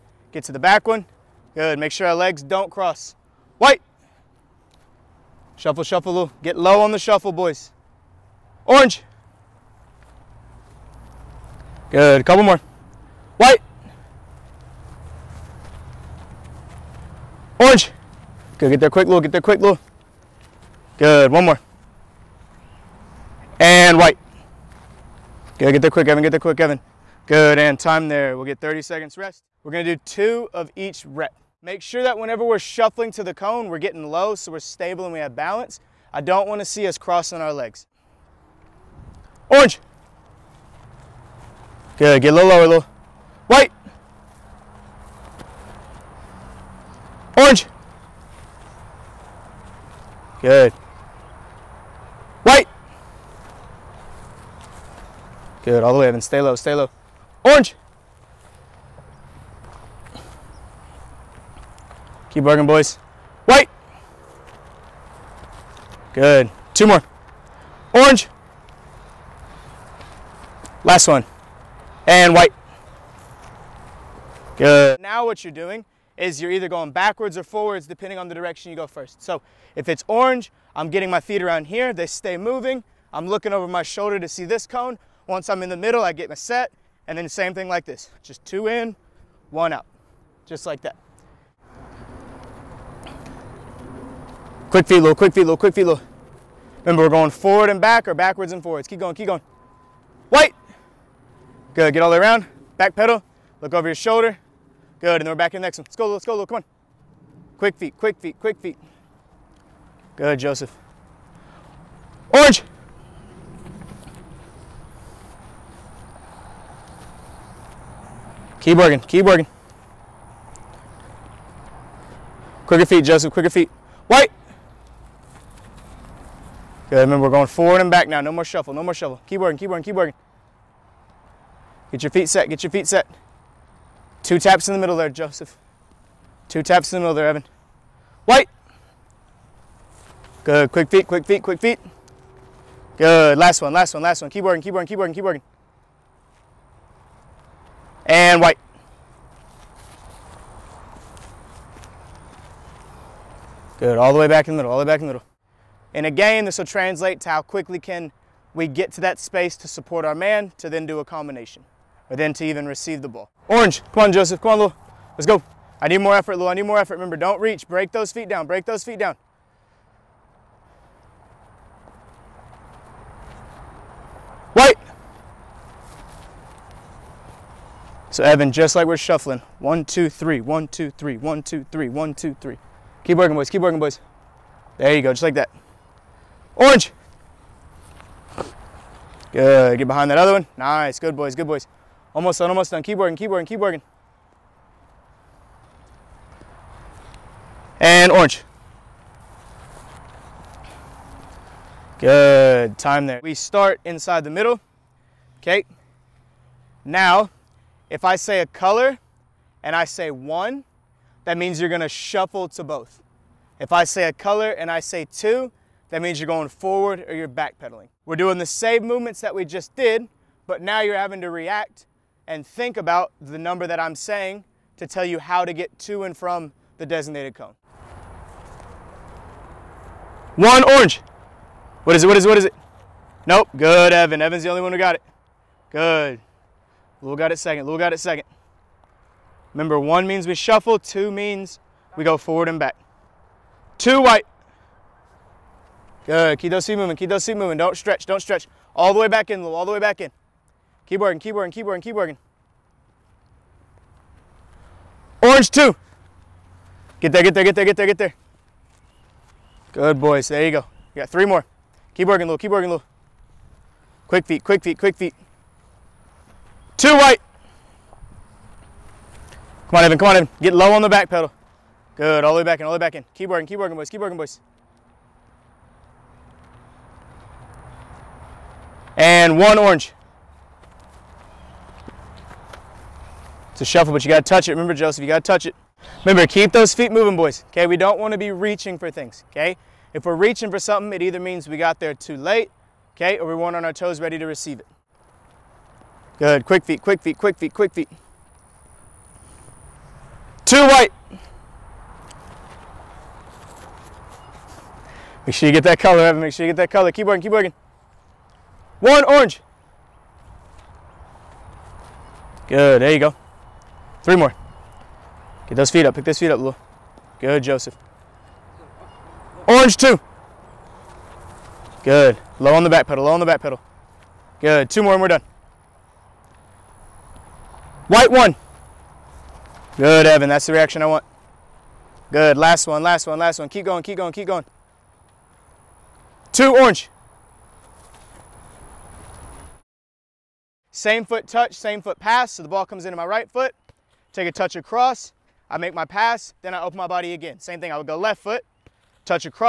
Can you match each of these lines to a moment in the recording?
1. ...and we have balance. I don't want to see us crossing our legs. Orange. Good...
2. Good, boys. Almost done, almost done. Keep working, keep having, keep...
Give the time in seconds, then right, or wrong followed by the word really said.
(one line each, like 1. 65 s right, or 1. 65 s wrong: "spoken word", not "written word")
1. 35 s right
2. 191 s wrong: "working", not "having".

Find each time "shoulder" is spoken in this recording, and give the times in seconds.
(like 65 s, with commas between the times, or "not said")
83 s, 103 s.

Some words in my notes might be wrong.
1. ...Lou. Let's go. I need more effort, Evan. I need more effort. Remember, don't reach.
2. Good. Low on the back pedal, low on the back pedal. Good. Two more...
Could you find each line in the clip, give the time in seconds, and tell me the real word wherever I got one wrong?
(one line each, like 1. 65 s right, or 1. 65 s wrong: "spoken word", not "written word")
1. 164 s wrong: "Lou", not "Evan"
2. 321 s right.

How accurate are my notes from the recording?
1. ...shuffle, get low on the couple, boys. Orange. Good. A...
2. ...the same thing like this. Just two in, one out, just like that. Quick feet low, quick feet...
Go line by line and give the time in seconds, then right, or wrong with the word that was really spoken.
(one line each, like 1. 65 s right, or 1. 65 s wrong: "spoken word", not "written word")
1. 5 s wrong: "shuffle", not "couple"
2. 87 s right.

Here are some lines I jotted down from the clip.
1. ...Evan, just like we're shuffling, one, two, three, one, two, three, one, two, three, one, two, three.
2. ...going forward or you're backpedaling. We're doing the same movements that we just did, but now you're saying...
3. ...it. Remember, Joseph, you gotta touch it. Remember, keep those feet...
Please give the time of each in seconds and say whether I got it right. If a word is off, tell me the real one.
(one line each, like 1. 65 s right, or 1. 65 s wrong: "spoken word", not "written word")
1. 178 s right
2. 216 s wrong: "having", not "saying"
3. 284 s right.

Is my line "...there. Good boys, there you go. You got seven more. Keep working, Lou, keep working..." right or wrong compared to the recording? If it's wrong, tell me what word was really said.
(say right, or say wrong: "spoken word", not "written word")
wrong: "three", not "seven".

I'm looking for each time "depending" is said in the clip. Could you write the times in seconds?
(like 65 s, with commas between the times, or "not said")
77 s.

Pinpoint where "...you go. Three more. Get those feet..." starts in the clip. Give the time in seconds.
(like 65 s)
312 s.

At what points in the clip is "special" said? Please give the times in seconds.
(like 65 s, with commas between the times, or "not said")
not said.